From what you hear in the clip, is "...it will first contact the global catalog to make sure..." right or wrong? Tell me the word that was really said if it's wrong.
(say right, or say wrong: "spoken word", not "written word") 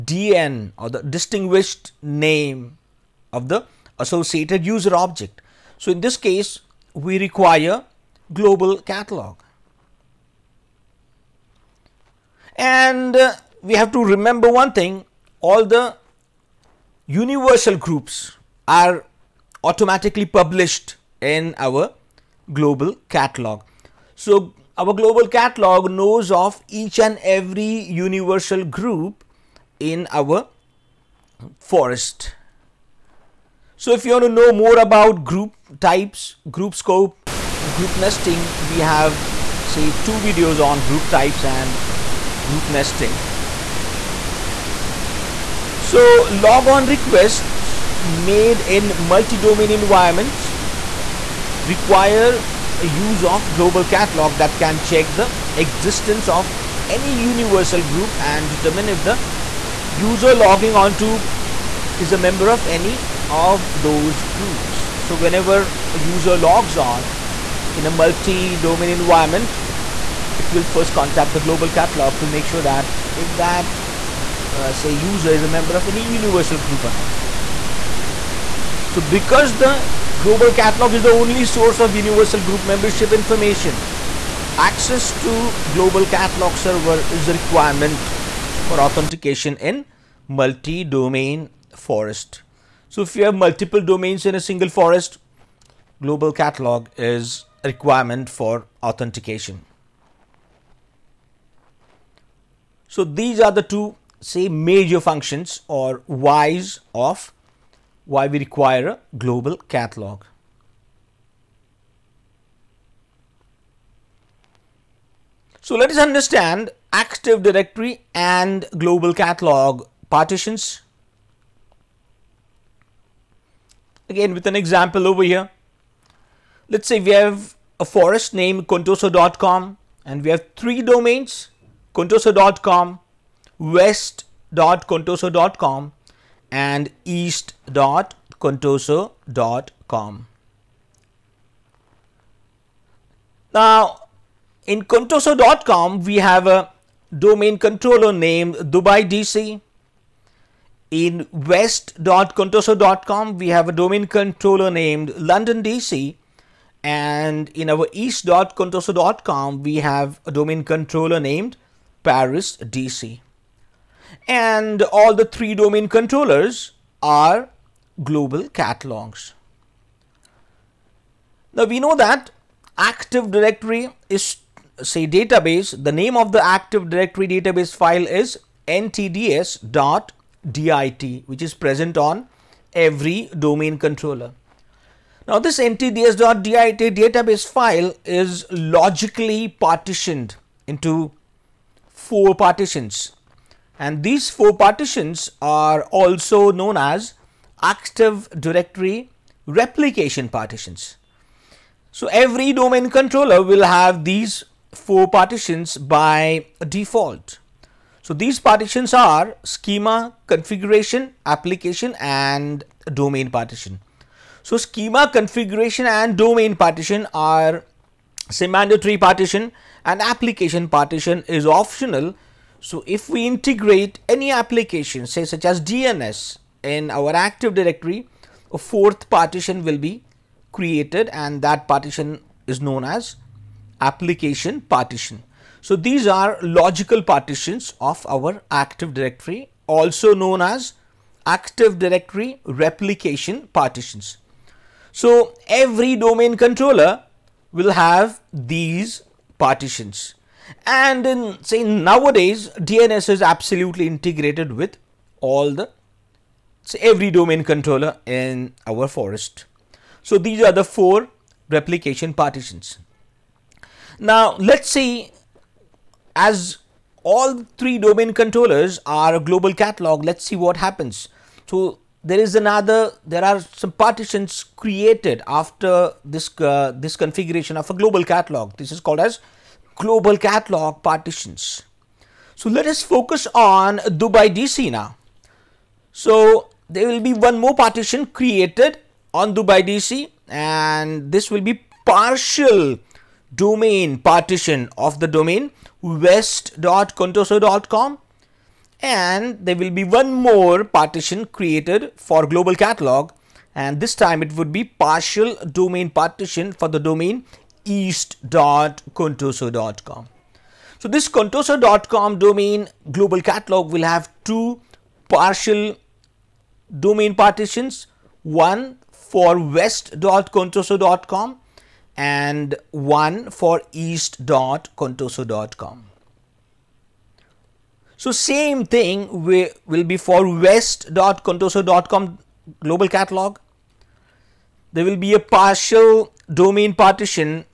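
right.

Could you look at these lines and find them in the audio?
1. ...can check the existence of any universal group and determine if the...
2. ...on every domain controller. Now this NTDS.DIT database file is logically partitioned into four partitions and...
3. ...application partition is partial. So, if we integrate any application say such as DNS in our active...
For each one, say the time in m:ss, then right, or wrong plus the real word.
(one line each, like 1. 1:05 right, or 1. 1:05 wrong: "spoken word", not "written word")
1. 0:54 right
2. 3:01 right
3. 3:39 wrong: "optional", not "partial".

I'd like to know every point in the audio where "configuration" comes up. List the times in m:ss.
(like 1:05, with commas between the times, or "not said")
3:30, 3:35, 4:36.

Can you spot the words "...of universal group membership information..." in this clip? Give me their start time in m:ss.
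1:21.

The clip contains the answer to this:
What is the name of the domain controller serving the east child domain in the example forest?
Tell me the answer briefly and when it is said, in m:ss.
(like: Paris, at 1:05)
Paris DC, at 2:42.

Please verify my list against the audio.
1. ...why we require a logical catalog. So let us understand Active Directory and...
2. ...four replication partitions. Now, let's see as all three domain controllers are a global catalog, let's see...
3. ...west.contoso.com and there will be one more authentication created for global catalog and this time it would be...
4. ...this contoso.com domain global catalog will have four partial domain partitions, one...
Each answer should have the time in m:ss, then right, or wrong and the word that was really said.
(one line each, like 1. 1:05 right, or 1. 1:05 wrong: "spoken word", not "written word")
1. 1:48 wrong: "global", not "logical"
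2. 4:20 right
3. 4:55 wrong: "partition", not "authentication"
4. 5:10 wrong: "two", not "four".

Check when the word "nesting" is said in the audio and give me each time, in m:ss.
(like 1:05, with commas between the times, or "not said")
0:37, 0:42.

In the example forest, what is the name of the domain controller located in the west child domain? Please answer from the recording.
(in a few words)
London DC.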